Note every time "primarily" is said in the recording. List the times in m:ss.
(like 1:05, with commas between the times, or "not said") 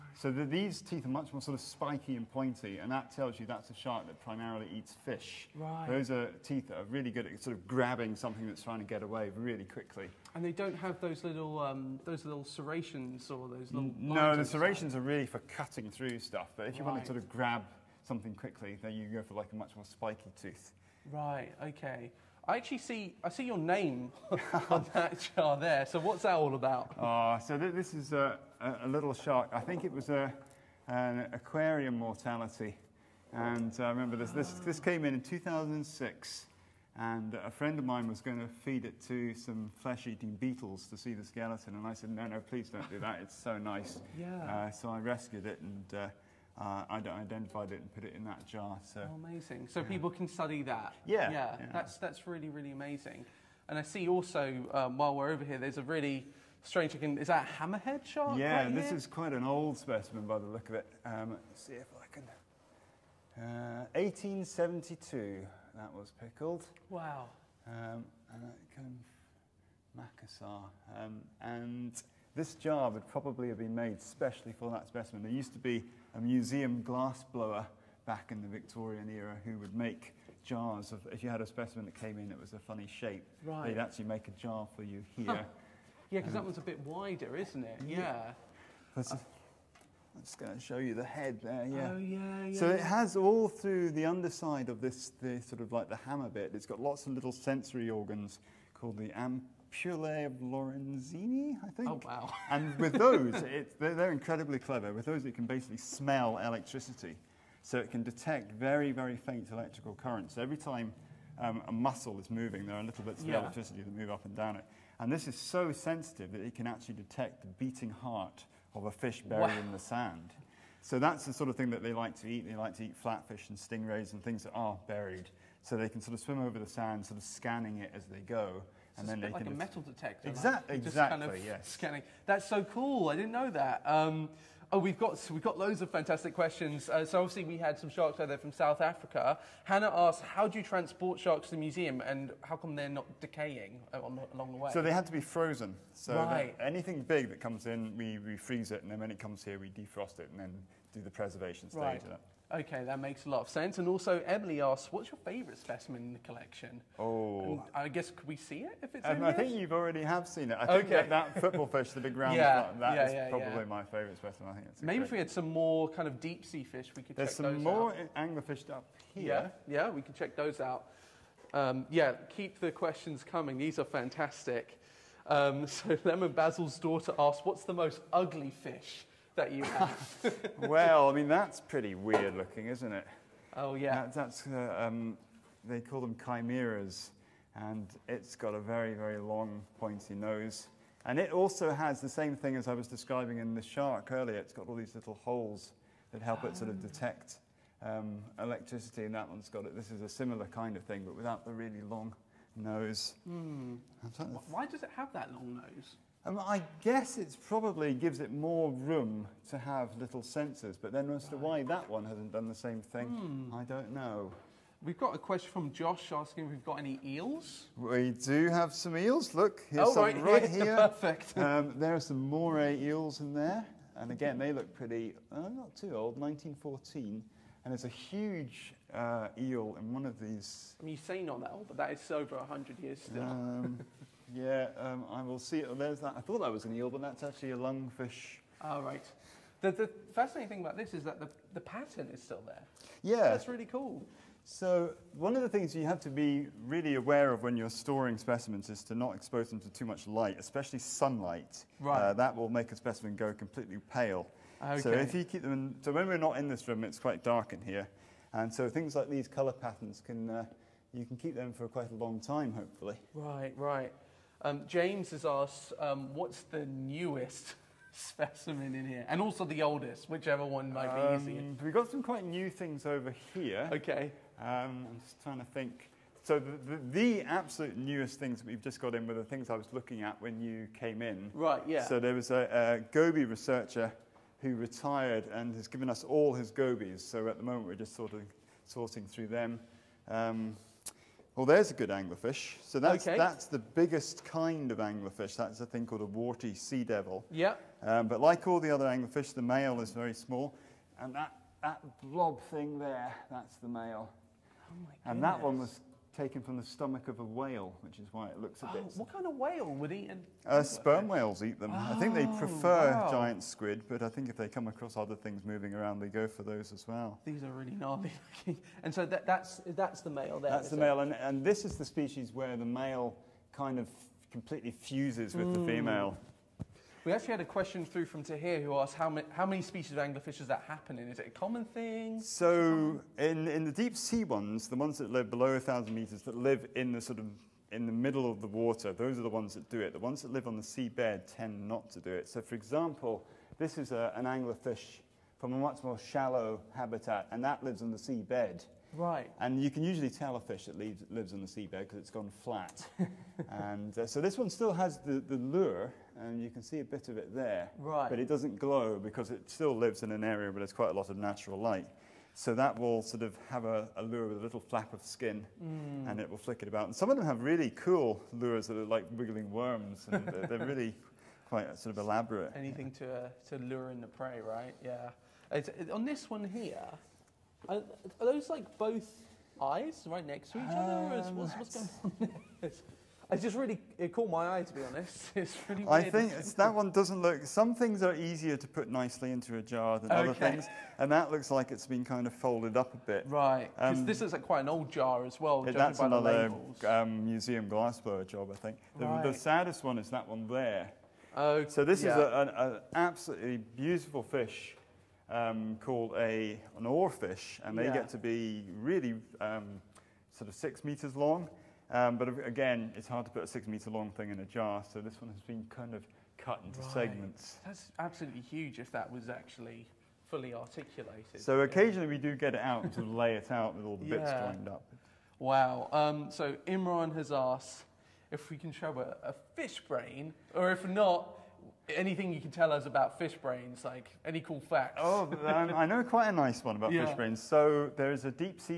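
0:04.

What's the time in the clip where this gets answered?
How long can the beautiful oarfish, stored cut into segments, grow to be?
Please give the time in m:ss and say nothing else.
6:50.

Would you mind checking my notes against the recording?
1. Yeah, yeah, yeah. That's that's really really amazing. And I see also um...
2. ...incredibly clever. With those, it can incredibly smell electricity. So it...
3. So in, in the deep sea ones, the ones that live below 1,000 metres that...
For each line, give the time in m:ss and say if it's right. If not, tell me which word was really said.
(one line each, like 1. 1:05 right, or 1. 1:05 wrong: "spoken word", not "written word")
1. 0:51 right
2. 1:44 wrong: "basically", not "incredibly"
3. 5:32 right.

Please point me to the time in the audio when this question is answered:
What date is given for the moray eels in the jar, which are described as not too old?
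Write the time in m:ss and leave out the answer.
3:46.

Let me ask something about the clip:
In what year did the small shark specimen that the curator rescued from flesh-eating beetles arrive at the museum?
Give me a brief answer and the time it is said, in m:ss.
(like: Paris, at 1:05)
2006, at 0:35.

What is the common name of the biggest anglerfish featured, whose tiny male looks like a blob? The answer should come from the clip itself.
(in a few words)
Warty sea devil.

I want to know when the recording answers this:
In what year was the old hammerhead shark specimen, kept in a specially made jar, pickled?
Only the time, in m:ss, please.
1:03.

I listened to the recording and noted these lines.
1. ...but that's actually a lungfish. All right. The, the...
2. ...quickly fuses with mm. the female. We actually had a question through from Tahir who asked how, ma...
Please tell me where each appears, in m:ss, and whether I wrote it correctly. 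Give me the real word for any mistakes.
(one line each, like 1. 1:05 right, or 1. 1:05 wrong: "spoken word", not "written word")
1. 3:56 right
2. 5:24 wrong: "completely", not "quickly".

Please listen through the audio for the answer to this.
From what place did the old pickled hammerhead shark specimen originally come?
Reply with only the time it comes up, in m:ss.
1:09.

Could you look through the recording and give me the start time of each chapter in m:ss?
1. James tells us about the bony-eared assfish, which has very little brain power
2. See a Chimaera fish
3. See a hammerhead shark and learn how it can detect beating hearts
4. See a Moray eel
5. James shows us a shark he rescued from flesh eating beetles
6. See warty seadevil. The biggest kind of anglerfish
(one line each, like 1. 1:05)
1. 7:05
2. 3:00
3. 0:53
4. 3:35
5. 0:23
6. 4:51.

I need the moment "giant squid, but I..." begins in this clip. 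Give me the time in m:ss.
5:13.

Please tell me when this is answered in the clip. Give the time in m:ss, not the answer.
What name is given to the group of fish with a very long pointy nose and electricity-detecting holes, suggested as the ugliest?
3:06.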